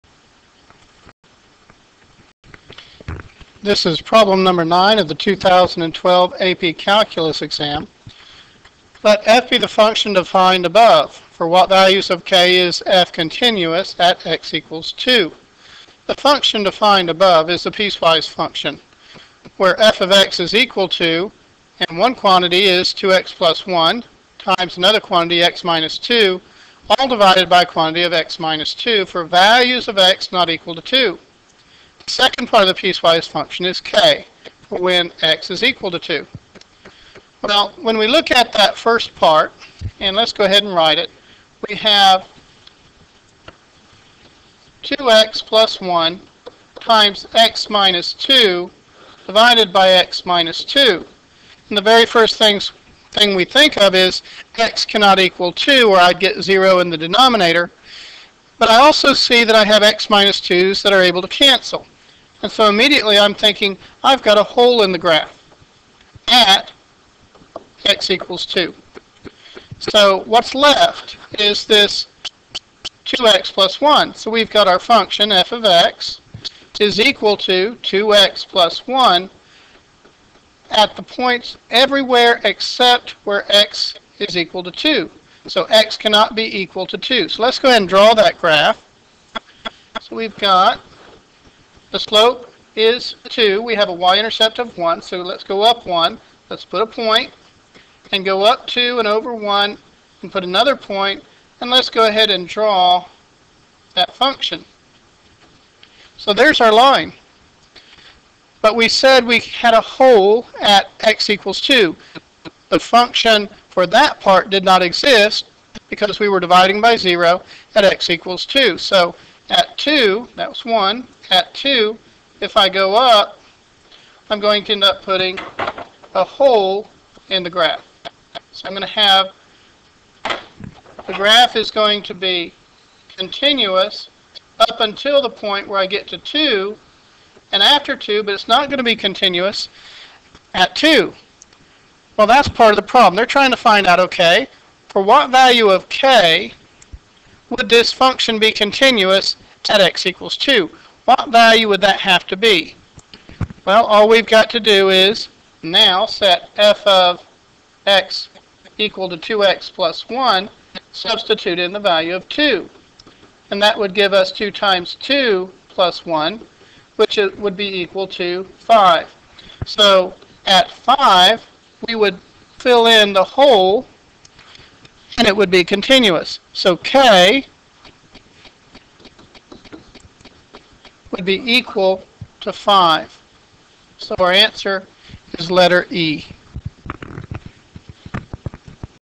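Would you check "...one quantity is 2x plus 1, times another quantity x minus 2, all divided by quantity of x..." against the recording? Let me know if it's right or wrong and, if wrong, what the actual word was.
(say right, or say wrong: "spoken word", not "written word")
right.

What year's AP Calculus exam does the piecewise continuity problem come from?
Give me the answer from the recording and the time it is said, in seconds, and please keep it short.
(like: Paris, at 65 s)
2012, at 5 s.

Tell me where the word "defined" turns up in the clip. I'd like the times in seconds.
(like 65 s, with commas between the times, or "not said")
10 s, 16 s.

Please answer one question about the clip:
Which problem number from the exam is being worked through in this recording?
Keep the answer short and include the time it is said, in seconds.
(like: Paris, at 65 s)
9, at 4 s.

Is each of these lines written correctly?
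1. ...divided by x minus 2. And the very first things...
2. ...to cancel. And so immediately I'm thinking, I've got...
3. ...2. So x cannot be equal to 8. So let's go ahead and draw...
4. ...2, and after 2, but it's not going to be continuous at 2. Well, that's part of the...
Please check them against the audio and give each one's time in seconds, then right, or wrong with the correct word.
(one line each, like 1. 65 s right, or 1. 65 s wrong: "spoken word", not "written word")
1. 49 s right
2. 61 s right
3. 84 s wrong: "2", not "8"
4. 136 s right.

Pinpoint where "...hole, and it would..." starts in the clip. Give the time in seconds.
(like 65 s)
173 s.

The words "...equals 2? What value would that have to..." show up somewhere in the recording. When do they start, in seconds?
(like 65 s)
150 s.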